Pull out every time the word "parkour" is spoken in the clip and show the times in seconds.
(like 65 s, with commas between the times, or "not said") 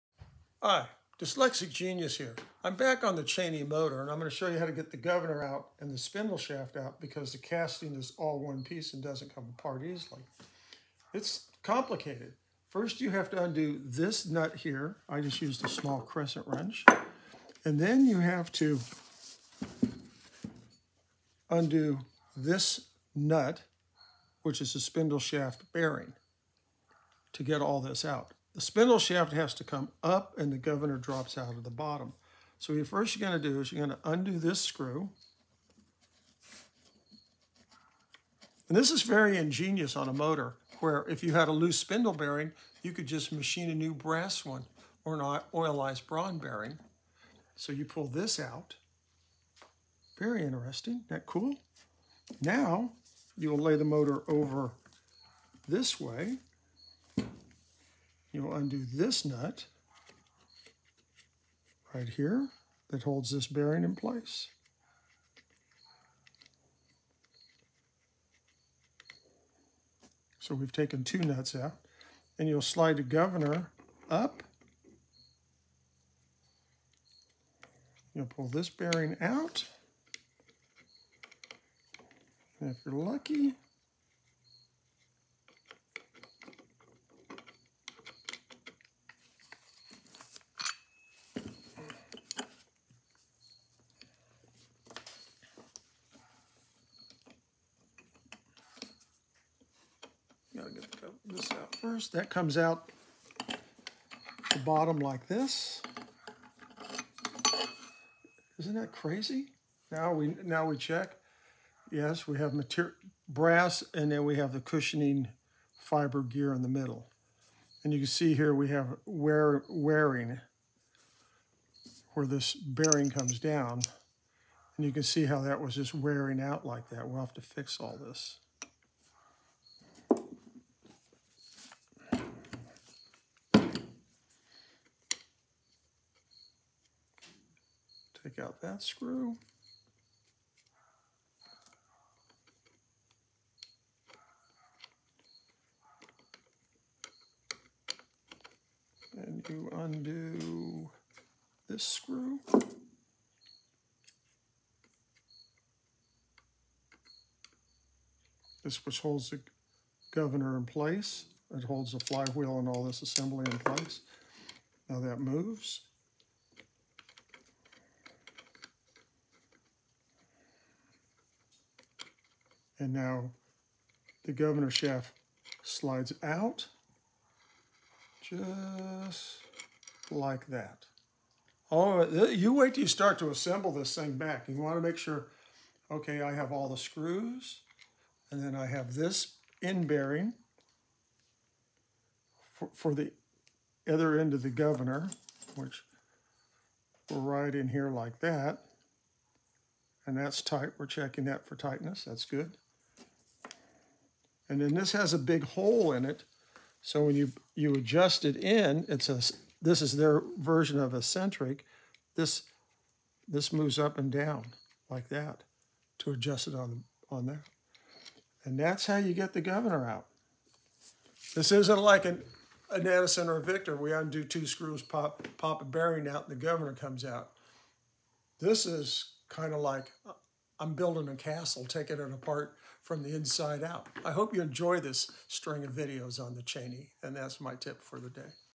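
not said.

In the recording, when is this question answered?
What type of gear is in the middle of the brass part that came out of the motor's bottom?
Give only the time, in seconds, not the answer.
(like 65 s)
114 s.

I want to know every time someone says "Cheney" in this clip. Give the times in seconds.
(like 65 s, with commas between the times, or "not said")
3 s, 236 s.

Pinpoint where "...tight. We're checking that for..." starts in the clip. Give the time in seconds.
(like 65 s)
200 s.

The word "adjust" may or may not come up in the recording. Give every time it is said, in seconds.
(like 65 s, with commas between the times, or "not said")
207 s, 216 s.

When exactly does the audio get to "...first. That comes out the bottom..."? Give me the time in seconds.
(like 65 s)
101 s.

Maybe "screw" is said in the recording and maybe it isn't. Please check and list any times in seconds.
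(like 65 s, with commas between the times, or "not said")
34 s, 138 s, 151 s, 186 s, 224 s.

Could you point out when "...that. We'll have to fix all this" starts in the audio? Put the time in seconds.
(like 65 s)
126 s.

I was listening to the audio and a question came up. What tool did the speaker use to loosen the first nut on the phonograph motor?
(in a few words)
small crescent wrench.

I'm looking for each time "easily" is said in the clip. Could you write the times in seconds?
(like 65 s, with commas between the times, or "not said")
9 s.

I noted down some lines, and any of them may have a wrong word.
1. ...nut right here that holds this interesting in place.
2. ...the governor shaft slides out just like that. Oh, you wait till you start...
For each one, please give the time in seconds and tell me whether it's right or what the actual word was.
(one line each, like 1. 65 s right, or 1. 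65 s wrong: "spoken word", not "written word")
1. 59 s wrong: "bearing", not "interesting"
2. 174 s right.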